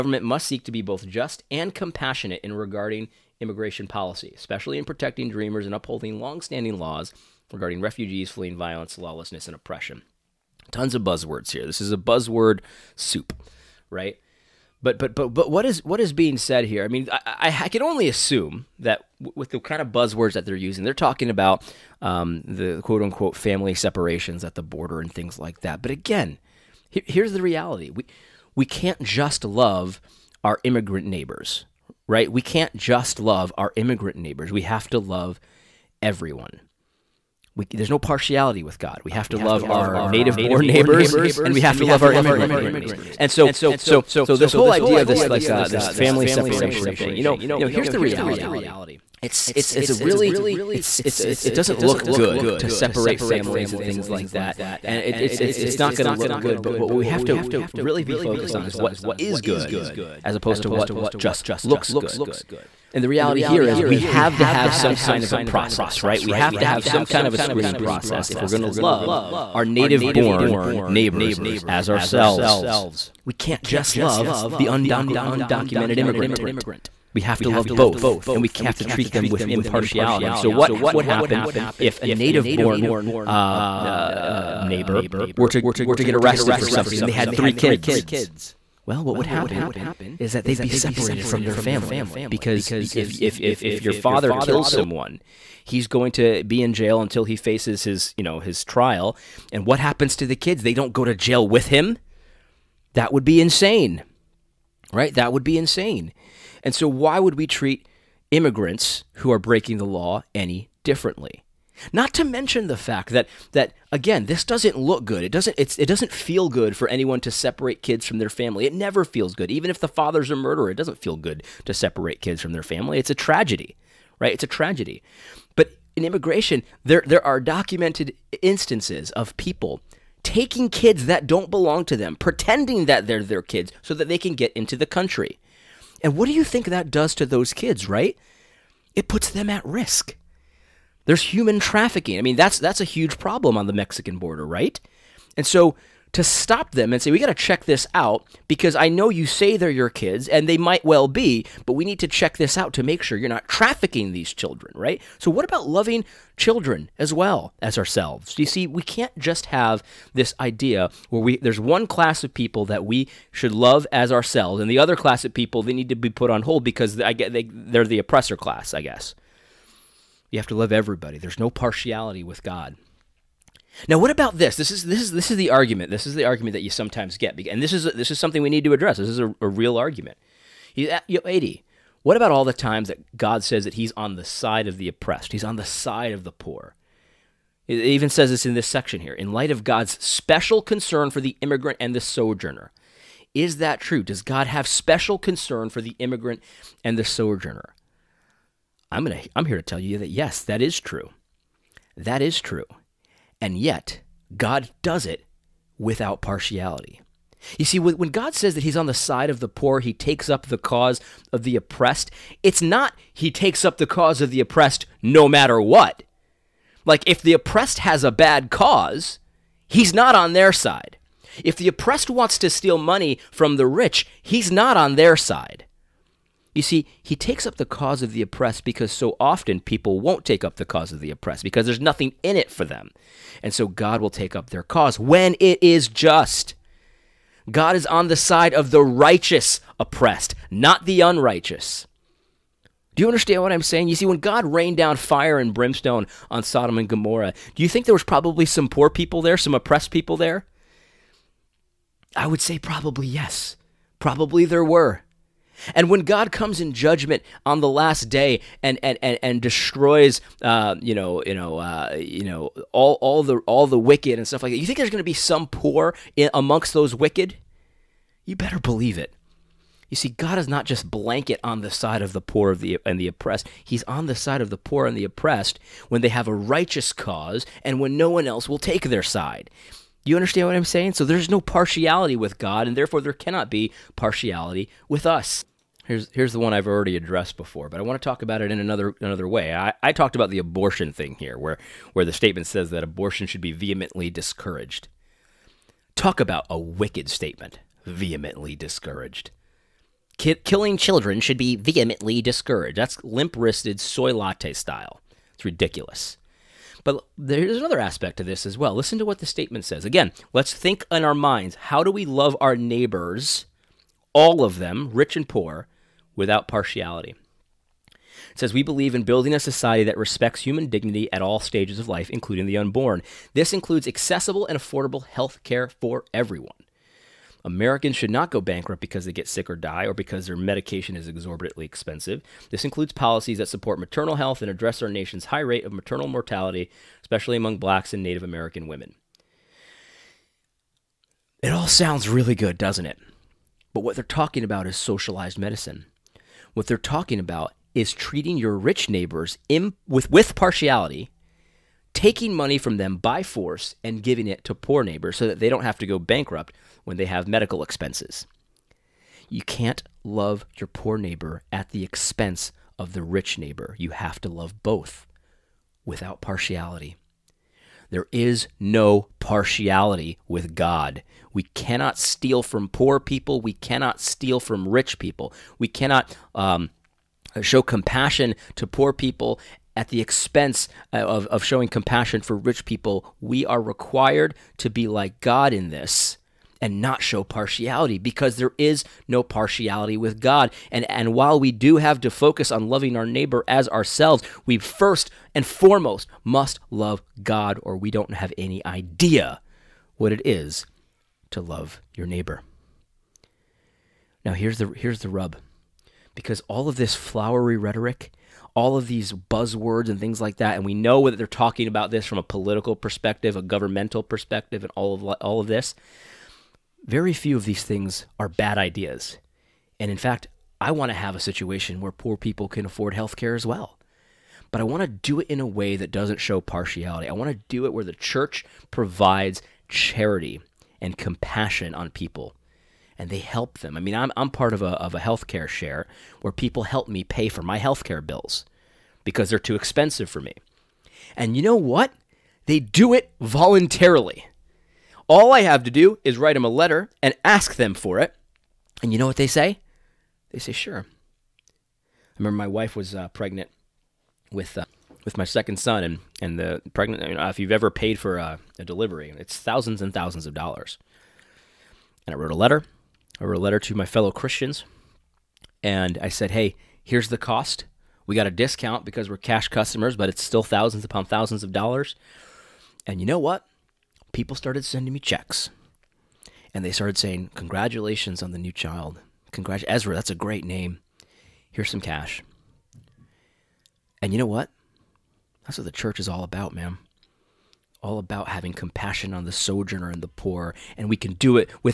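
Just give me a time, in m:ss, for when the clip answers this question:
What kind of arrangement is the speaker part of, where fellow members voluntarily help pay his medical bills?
7:14.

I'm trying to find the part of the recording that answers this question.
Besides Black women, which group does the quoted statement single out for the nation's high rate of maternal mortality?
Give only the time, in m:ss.
5:38.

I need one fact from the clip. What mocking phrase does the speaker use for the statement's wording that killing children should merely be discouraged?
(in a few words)
limp wristed soy latte style.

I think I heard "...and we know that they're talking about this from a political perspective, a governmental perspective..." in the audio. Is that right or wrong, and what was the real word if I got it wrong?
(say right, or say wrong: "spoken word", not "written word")
right.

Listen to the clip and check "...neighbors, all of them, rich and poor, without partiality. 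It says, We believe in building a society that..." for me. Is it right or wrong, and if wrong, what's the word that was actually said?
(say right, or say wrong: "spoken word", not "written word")
right.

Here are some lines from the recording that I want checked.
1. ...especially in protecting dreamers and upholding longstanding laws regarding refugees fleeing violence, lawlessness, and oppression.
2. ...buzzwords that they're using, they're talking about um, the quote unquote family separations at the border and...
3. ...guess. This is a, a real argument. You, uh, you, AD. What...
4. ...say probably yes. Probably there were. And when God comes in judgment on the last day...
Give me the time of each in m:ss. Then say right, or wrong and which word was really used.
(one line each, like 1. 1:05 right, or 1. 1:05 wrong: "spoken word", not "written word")
1. 0:04 right
2. 0:19 right
3. 2:58 wrong: "address", not "guess"
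4. 4:12 right.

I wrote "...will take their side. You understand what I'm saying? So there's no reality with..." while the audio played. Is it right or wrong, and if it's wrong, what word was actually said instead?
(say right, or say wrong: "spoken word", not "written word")
wrong: "partiality", not "reality".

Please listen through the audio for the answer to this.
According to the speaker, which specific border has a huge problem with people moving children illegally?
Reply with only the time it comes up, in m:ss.
2:23.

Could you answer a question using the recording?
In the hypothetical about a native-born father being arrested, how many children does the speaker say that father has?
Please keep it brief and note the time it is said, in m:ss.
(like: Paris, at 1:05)
3, at 1:27.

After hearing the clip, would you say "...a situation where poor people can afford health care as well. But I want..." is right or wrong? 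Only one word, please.
right.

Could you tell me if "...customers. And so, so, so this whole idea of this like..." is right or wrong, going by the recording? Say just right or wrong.
wrong.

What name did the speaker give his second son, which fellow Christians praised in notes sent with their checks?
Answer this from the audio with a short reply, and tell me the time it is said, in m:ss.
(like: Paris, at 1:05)
Ezra, at 7:59.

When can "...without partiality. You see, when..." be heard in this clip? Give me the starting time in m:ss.
3:25.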